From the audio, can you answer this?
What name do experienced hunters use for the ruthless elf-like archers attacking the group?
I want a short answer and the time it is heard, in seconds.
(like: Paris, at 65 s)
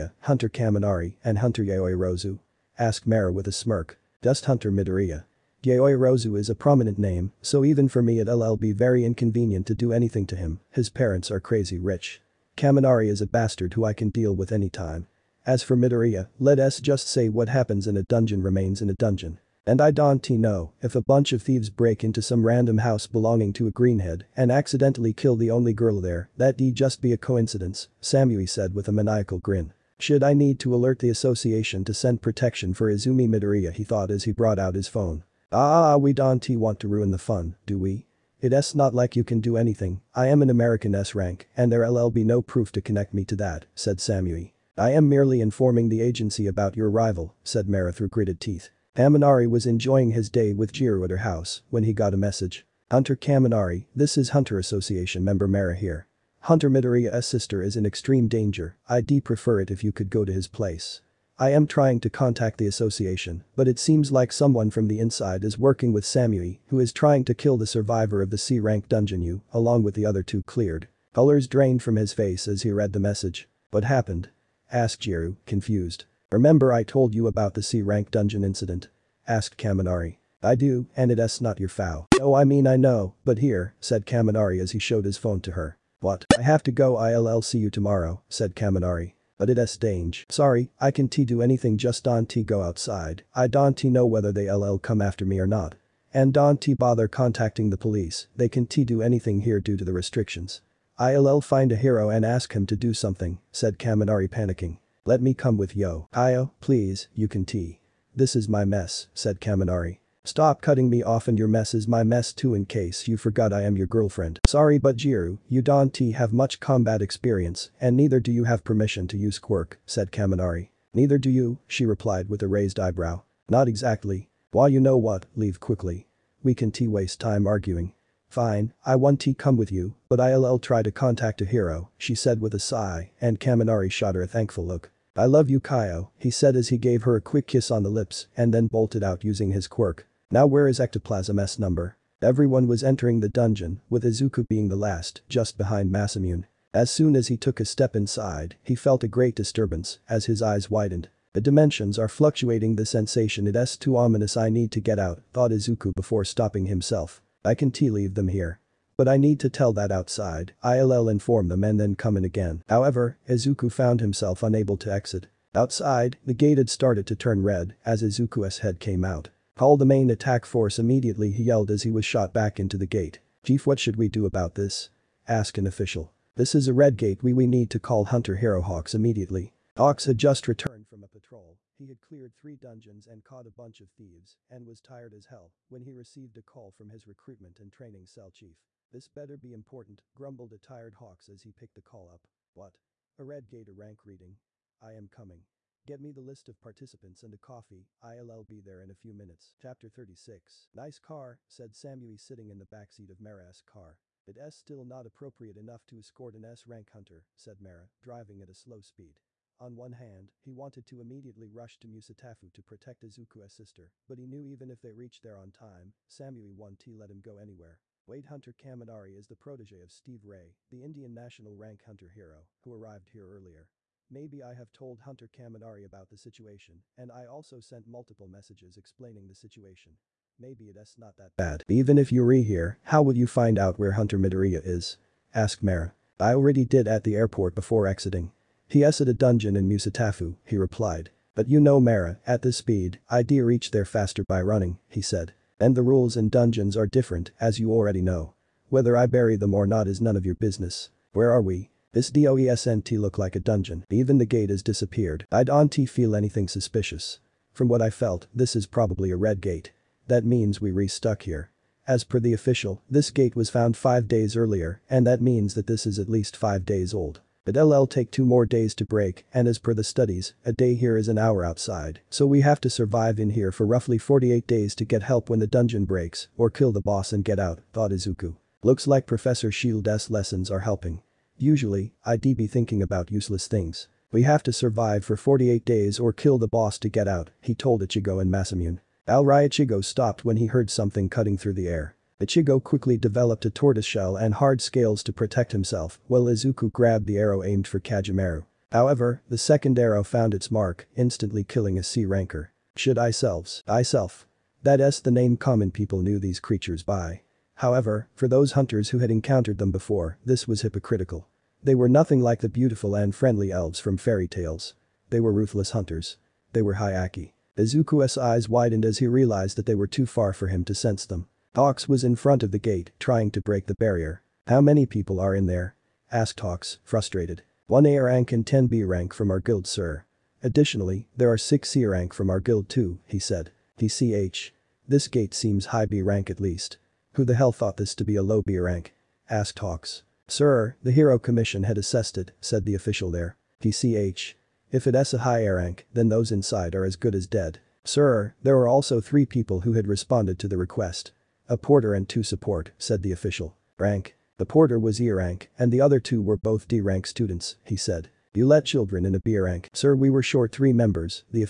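Hayaki, at 316 s.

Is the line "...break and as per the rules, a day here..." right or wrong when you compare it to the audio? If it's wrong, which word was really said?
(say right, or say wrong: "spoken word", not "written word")
wrong: "studies", not "rules".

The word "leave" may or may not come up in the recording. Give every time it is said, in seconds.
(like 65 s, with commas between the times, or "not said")
125 s, 157 s.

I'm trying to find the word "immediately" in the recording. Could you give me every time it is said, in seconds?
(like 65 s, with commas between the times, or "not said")
170 s, 178 s, 210 s.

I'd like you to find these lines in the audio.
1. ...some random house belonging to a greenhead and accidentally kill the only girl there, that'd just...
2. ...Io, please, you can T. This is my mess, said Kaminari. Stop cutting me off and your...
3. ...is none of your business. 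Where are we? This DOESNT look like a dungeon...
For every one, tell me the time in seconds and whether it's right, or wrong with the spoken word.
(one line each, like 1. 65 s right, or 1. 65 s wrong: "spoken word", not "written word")
1. 22 s right
2. 106 s right
3. 249 s right.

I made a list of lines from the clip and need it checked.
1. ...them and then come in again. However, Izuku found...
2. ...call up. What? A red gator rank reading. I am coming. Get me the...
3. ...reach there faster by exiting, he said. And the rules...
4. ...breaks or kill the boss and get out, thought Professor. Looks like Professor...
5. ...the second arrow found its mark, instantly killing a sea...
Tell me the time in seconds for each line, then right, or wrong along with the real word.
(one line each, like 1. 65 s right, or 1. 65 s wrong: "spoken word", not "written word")
1. 161 s right
2. 191 s right
3. 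243 s wrong: "running", not "exiting"
4. 275 s wrong: "Izuku", not "Professor"
5. 299 s right.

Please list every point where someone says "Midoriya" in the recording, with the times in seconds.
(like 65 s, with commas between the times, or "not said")
4 s, 15 s, 33 s, 56 s, 234 s.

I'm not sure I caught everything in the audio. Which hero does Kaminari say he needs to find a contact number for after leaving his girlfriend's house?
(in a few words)
Ectoplasm.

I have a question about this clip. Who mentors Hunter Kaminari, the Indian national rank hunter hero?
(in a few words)
Steve Ray.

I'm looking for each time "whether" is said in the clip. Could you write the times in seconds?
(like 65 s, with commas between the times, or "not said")
94 s, 248 s.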